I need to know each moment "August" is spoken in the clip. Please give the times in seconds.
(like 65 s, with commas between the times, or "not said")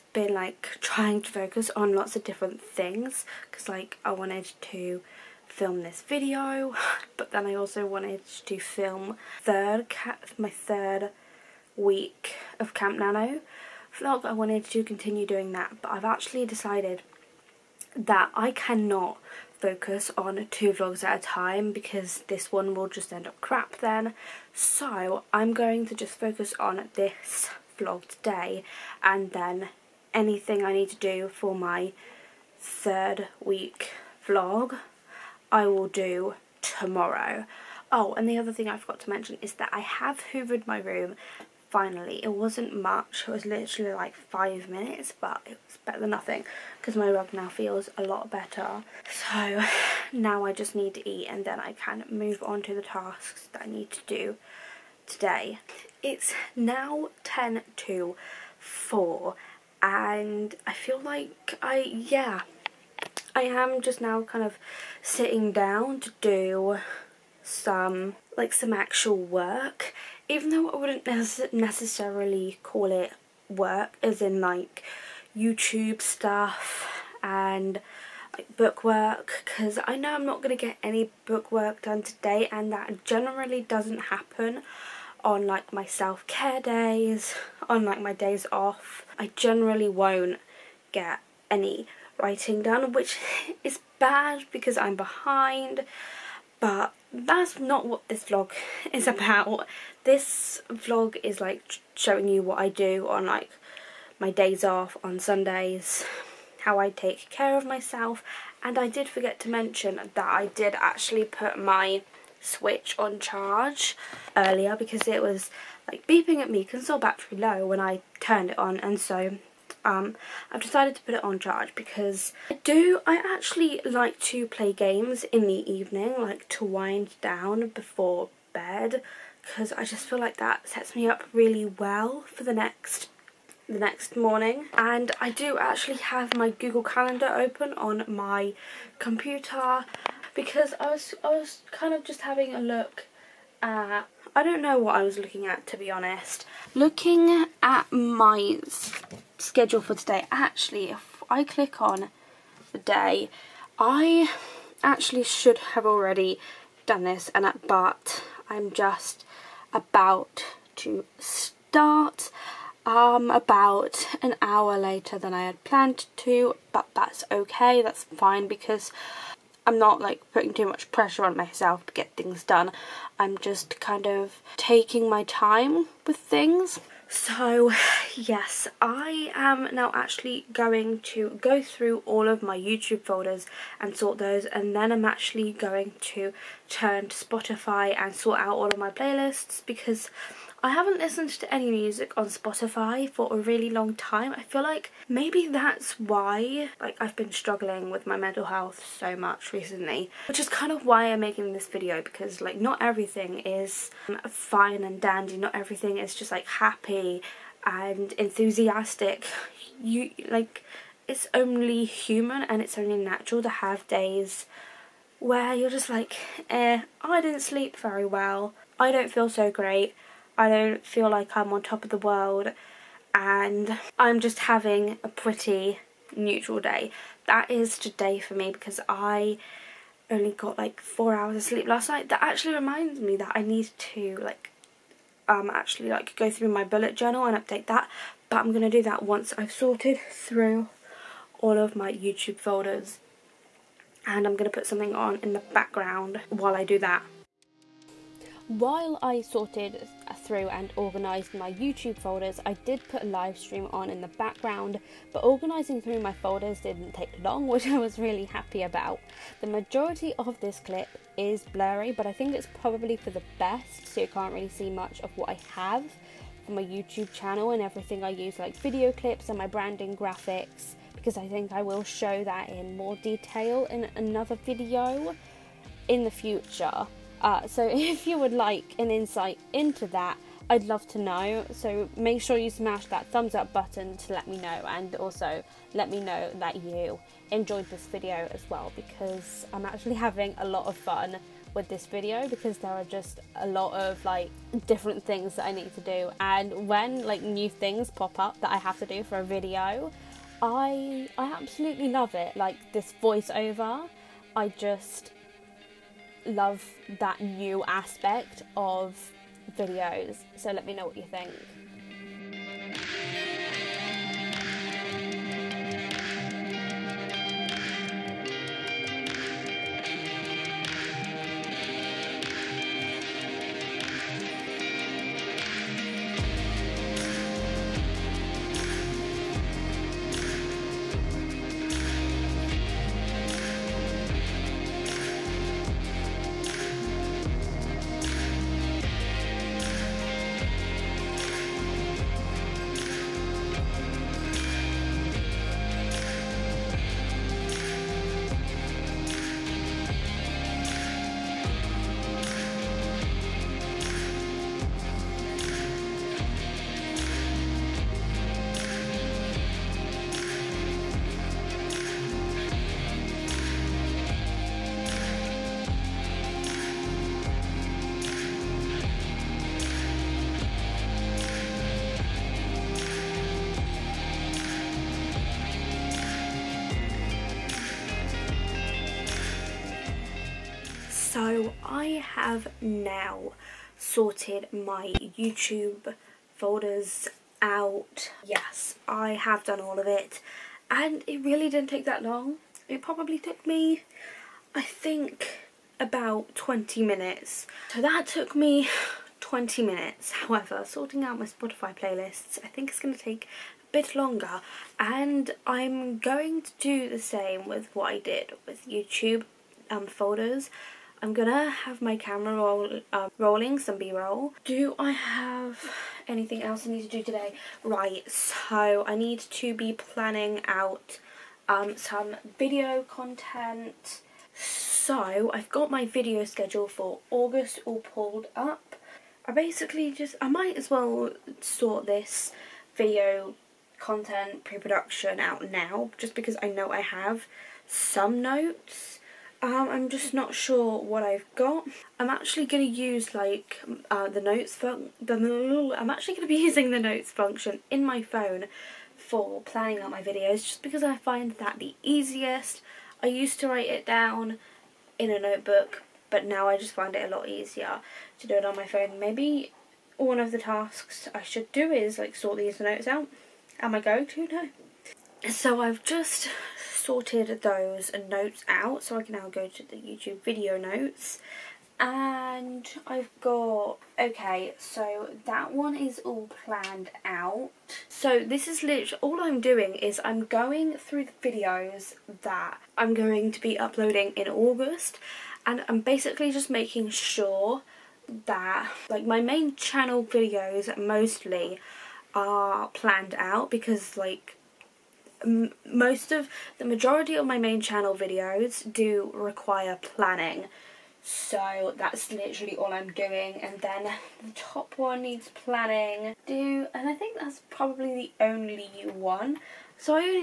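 427 s, 484 s.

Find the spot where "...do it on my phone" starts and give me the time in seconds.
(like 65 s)
458 s.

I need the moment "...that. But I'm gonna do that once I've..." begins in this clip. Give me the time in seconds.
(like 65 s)
237 s.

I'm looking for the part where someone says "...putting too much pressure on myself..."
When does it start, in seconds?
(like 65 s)
170 s.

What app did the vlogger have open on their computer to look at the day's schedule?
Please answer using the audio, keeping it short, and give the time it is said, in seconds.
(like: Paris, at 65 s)
Google Calendar, at 136 s.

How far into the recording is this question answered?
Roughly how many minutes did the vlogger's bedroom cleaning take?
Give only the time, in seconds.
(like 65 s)
44 s.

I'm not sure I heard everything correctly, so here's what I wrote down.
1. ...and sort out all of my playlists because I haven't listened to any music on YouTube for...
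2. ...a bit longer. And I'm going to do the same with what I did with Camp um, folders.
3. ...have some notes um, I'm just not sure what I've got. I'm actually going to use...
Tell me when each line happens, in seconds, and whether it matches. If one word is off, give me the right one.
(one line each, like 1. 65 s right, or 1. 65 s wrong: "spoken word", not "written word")
1. 187 s wrong: "Spotify", not "YouTube"
2. 403 s wrong: "YouTube", not "Camp"
3. 436 s right.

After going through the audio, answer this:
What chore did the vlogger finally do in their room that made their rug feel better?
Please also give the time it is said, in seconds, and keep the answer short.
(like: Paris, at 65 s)
Hoovered, at 40 s.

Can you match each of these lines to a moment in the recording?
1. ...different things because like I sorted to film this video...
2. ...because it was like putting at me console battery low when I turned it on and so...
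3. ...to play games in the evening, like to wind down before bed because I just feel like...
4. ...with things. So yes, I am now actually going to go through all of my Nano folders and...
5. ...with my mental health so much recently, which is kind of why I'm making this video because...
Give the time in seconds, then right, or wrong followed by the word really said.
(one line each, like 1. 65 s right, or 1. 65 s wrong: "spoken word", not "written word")
1. 2 s wrong: "wanted", not "sorted"
2. 114 s wrong: "beeping", not "putting"
3. 124 s right
4. 176 s wrong: "YouTube", not "Nano"
5. 197 s right.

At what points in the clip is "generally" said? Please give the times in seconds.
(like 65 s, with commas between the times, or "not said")
83 s, 89 s.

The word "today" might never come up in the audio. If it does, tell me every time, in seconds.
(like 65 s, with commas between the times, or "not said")
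28 s, 55 s, 82 s, 149 s, 227 s, 417 s.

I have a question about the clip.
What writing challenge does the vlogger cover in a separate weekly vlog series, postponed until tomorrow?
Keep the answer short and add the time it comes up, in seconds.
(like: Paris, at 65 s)
Camp Nano, at 12 s.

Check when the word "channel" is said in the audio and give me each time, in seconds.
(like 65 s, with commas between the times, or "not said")
267 s, 489 s, 497 s.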